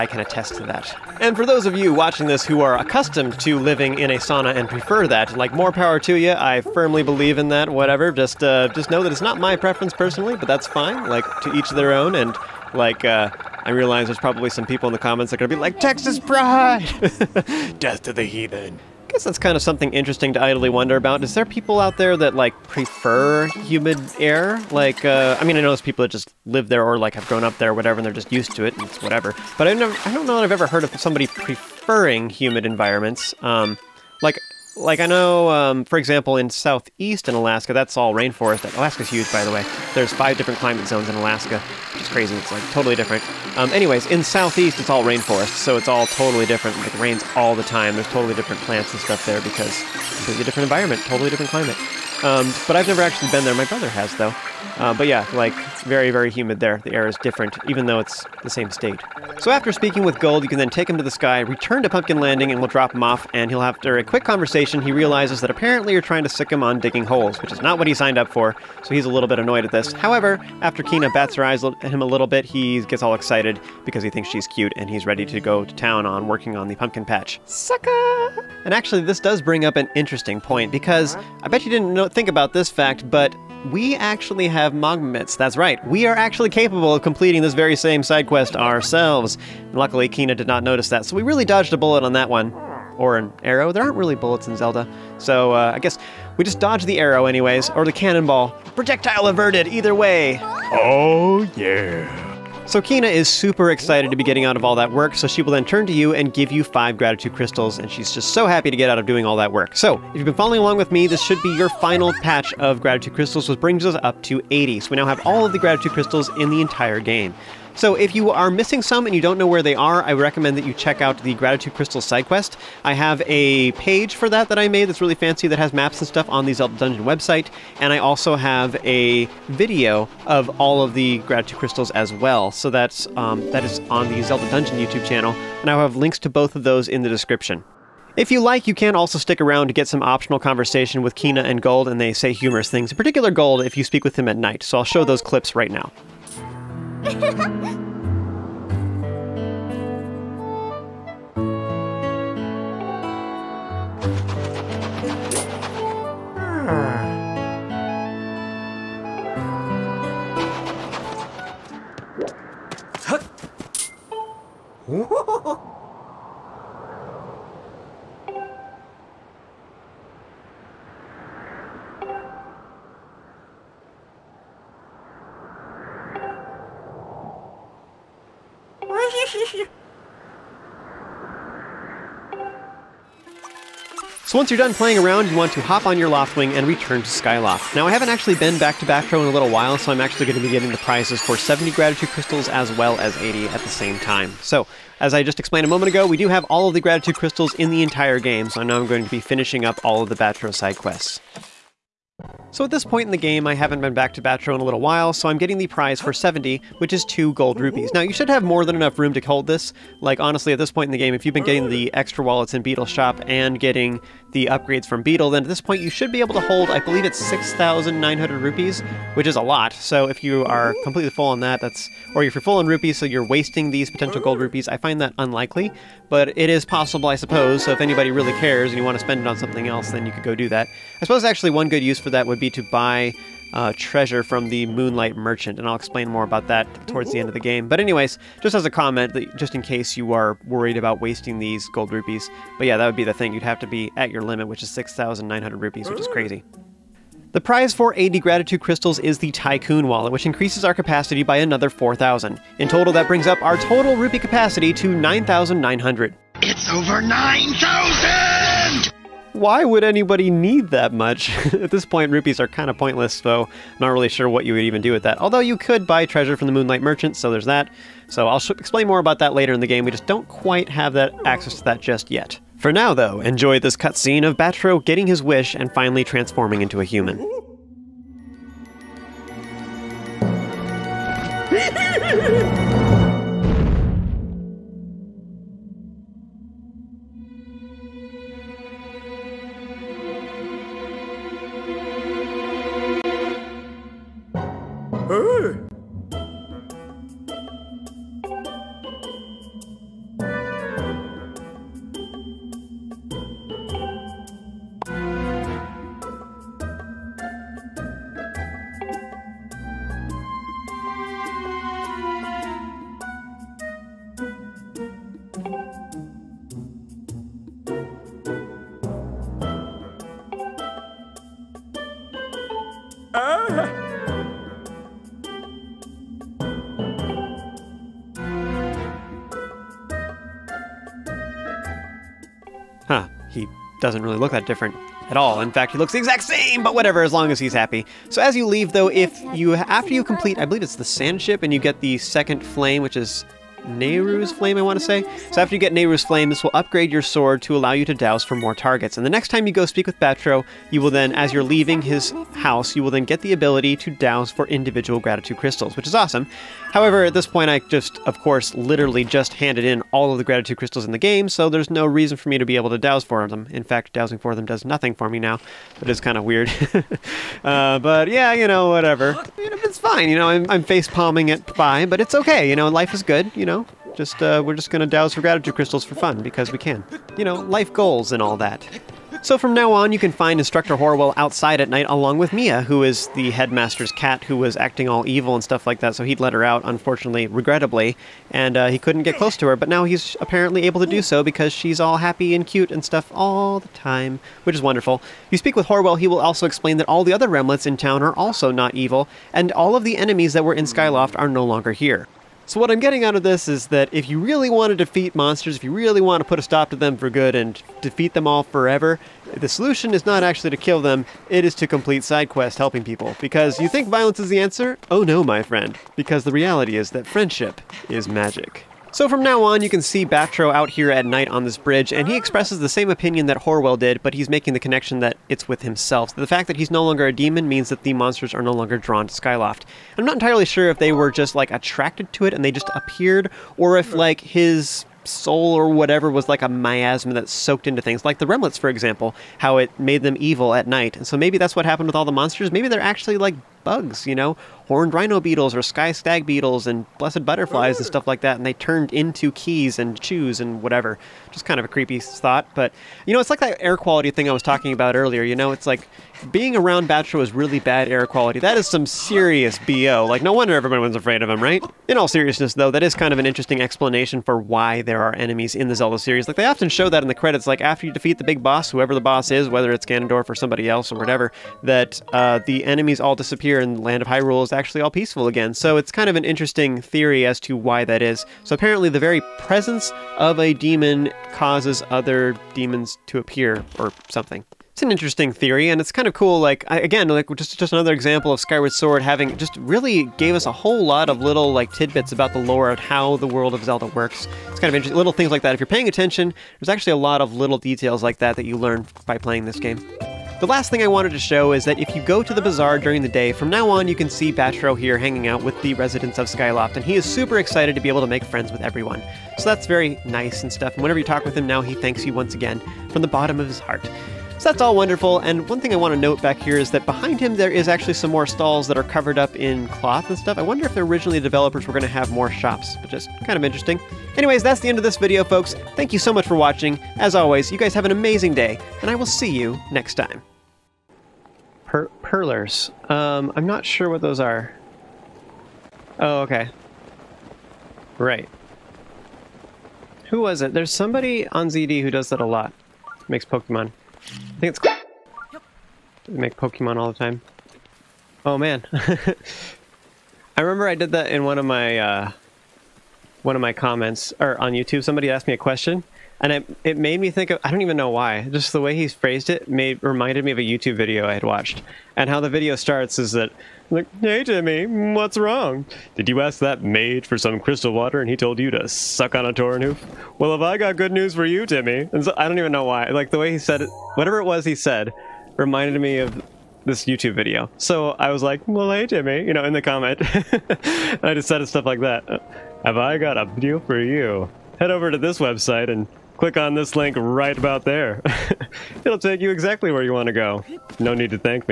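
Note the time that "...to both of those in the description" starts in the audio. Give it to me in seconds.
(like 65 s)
136 s.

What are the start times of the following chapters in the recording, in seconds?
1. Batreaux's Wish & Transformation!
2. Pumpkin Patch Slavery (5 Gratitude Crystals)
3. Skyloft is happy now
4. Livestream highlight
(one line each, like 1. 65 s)
1. 194 s
2. 58 s
3. 378 s
4. 530 s.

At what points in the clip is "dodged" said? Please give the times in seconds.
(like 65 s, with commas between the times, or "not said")
91 s, 96 s.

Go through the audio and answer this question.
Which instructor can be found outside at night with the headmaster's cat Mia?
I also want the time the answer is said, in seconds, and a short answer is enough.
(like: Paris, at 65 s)
Instructor Horwell, at 380 s.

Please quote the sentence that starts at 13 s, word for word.
Uh, I realize there's probably some people in the comments that are going to be like, Texas Pride!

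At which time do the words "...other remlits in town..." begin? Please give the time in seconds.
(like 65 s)
397 s.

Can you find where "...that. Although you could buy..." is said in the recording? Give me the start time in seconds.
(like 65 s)
265 s.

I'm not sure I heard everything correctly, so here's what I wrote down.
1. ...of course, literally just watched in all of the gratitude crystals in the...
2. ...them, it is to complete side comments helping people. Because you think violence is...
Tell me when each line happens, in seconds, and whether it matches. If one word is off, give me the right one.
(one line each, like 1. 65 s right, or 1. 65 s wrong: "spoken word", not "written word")
1. 357 s wrong: "handed", not "watched"
2. 410 s wrong: "quests", not "comments".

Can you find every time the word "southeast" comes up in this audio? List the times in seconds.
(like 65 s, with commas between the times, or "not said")
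36 s, 44 s.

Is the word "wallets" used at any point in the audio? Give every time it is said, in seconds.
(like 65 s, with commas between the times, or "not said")
212 s, 249 s.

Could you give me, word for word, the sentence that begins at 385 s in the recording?
So he'd let her out, unfortunately, regrettably, and uh, he couldn't get close to her.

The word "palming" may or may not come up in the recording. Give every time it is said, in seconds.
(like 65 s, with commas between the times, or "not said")
370 s.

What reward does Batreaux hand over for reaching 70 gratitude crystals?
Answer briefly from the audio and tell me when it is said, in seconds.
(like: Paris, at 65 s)
2 gold rupees, at 207 s.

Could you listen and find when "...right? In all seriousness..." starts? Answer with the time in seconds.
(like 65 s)
461 s.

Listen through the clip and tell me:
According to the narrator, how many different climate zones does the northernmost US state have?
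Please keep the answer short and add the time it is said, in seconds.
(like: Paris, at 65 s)
5, at 40 s.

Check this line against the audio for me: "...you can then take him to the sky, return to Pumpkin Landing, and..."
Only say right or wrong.
right.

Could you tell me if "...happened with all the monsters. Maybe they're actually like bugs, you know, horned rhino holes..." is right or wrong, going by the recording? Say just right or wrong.
wrong.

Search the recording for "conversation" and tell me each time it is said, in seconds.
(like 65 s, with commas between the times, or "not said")
64 s, 140 s.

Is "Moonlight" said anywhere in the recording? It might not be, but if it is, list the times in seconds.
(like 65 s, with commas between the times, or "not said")
234 s, 266 s.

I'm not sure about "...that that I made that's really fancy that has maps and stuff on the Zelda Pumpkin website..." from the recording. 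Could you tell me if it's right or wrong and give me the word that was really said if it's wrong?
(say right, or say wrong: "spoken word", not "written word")
wrong: "Dungeon", not "Pumpkin".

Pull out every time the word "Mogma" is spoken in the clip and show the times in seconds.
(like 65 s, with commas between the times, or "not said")
84 s.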